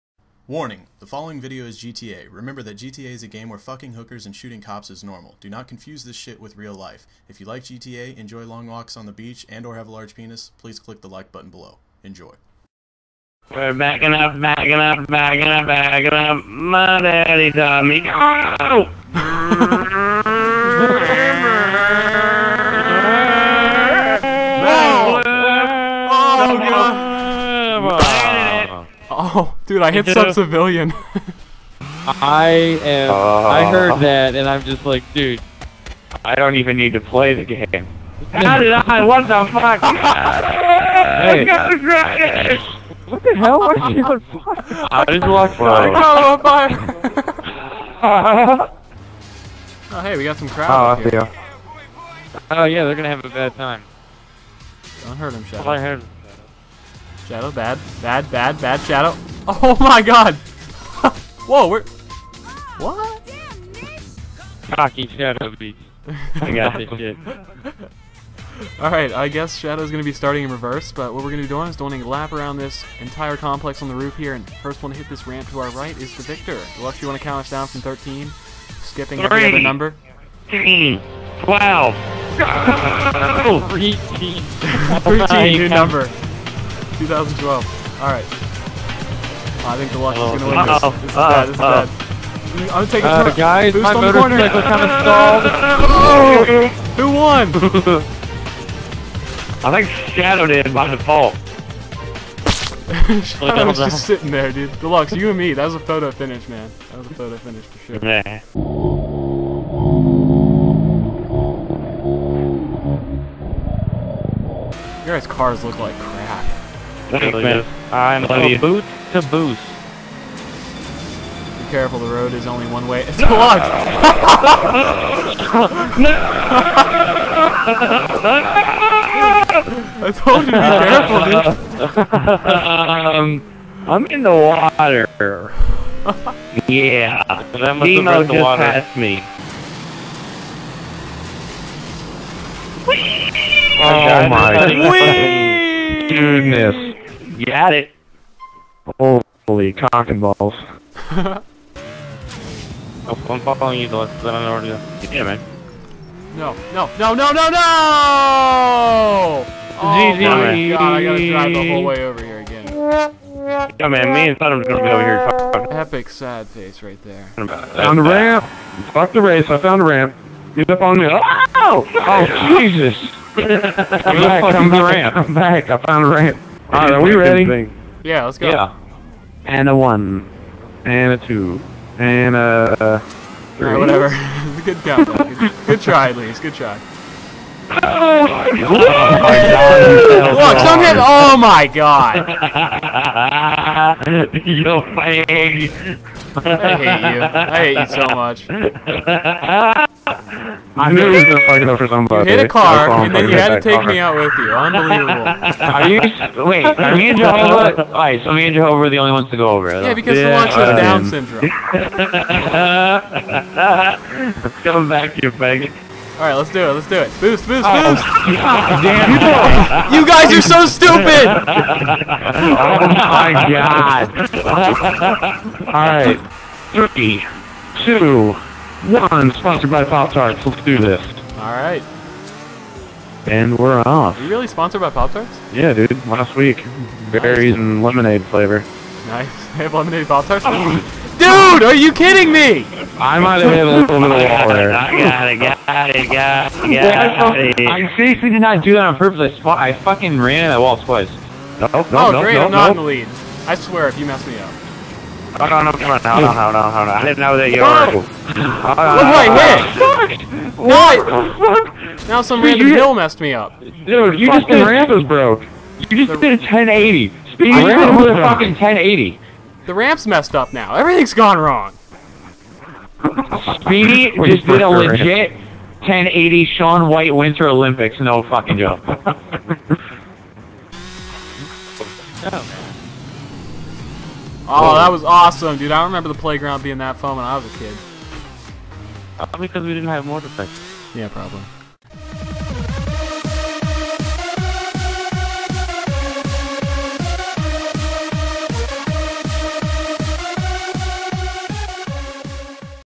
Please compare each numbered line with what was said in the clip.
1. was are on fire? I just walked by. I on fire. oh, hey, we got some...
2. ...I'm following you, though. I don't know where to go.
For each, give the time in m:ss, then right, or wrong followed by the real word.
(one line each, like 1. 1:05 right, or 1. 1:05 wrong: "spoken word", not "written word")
1. 0:43 right
2. 2:33 right.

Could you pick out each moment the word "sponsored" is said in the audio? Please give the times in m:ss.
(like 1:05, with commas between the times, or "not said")
3:49, 3:54.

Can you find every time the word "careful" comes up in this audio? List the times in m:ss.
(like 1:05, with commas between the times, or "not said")
2:01, 2:10.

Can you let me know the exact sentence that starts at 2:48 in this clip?
Fuck the race, I found a ramp.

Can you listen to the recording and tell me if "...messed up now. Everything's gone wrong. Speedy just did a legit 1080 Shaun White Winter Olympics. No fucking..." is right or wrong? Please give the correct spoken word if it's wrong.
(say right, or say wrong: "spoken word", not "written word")
right.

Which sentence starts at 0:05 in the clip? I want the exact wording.
Do not confuse this shit with real life.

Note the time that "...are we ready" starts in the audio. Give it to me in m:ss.
2:56.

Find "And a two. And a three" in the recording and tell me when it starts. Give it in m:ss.
3:00.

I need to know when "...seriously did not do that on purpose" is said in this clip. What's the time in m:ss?
4:07.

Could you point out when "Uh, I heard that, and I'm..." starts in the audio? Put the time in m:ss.
0:33.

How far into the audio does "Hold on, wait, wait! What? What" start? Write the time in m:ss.
4:18.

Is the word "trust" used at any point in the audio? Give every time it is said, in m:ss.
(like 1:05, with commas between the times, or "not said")
not said.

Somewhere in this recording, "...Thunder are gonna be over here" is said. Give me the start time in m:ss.
2:44.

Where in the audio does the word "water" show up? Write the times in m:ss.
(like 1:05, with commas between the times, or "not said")
2:14, 2:18, 4:04.